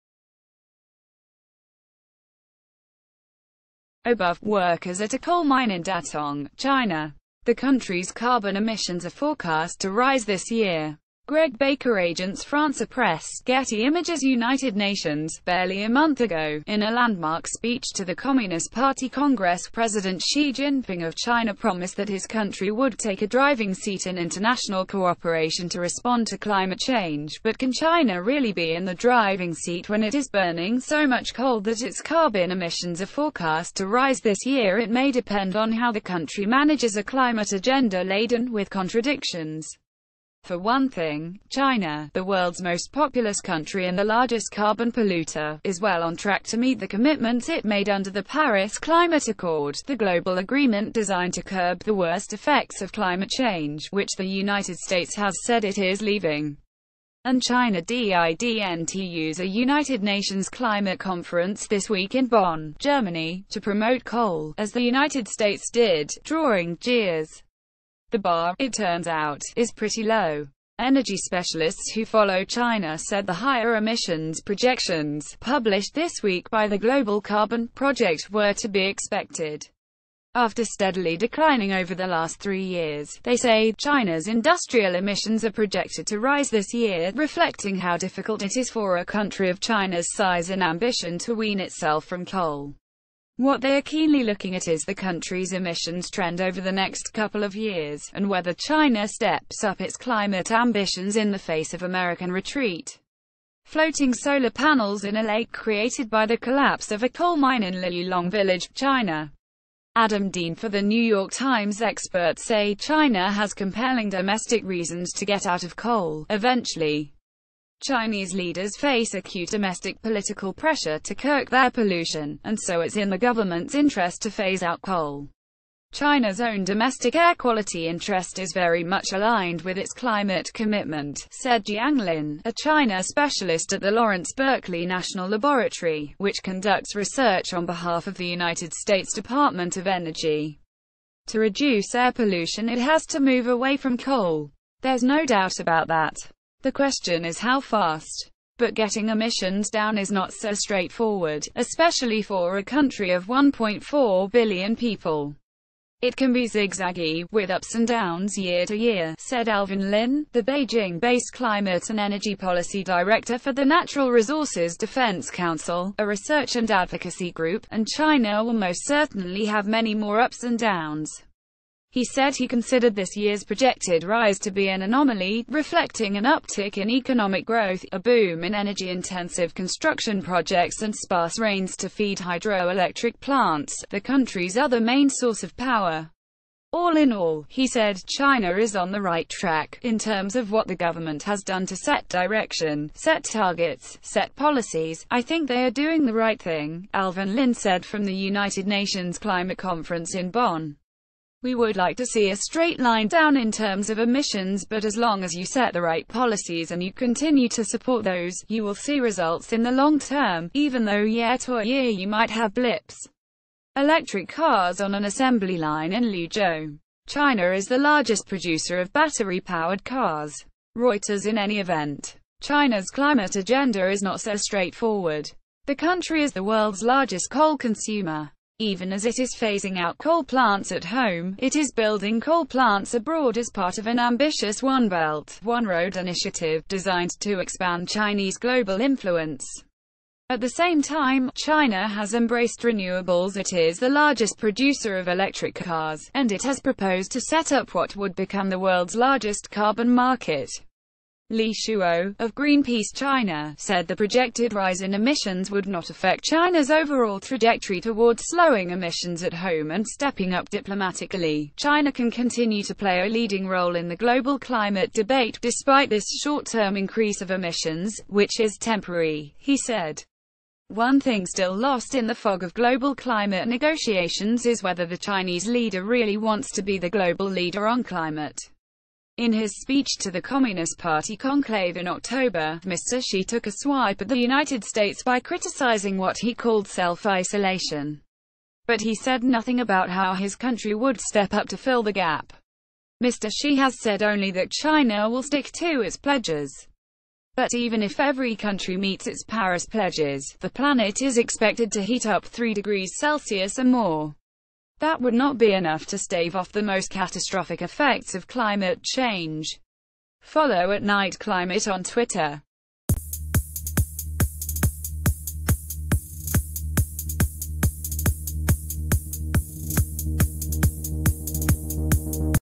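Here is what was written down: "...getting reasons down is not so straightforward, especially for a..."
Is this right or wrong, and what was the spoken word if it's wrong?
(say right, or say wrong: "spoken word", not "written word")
wrong: "emissions", not "reasons".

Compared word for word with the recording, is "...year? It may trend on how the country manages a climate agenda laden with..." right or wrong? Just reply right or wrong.
wrong.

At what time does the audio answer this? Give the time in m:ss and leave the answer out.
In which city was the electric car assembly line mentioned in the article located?
3:36.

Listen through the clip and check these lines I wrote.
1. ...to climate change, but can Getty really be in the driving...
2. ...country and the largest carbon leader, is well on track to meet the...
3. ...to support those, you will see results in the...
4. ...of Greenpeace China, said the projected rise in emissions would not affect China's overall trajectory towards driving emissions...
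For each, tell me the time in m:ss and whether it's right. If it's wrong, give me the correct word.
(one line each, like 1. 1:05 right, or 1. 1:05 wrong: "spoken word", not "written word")
1. 0:26 wrong: "China", not "Getty"
2. 0:43 wrong: "polluter", not "leader"
3. 3:27 right
4. 4:12 wrong: "slowing", not "driving".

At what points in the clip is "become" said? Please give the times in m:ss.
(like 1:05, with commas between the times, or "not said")
4:08.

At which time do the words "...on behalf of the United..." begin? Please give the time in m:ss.
2:17.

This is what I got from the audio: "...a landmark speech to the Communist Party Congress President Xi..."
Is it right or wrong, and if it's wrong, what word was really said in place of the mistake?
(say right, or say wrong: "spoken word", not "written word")
right.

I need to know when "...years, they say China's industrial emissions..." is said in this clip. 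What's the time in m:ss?
1:22.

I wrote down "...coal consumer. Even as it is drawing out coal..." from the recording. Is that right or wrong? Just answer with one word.
wrong.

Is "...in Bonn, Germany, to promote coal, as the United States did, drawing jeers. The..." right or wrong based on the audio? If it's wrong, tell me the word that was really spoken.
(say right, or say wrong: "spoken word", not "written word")
right.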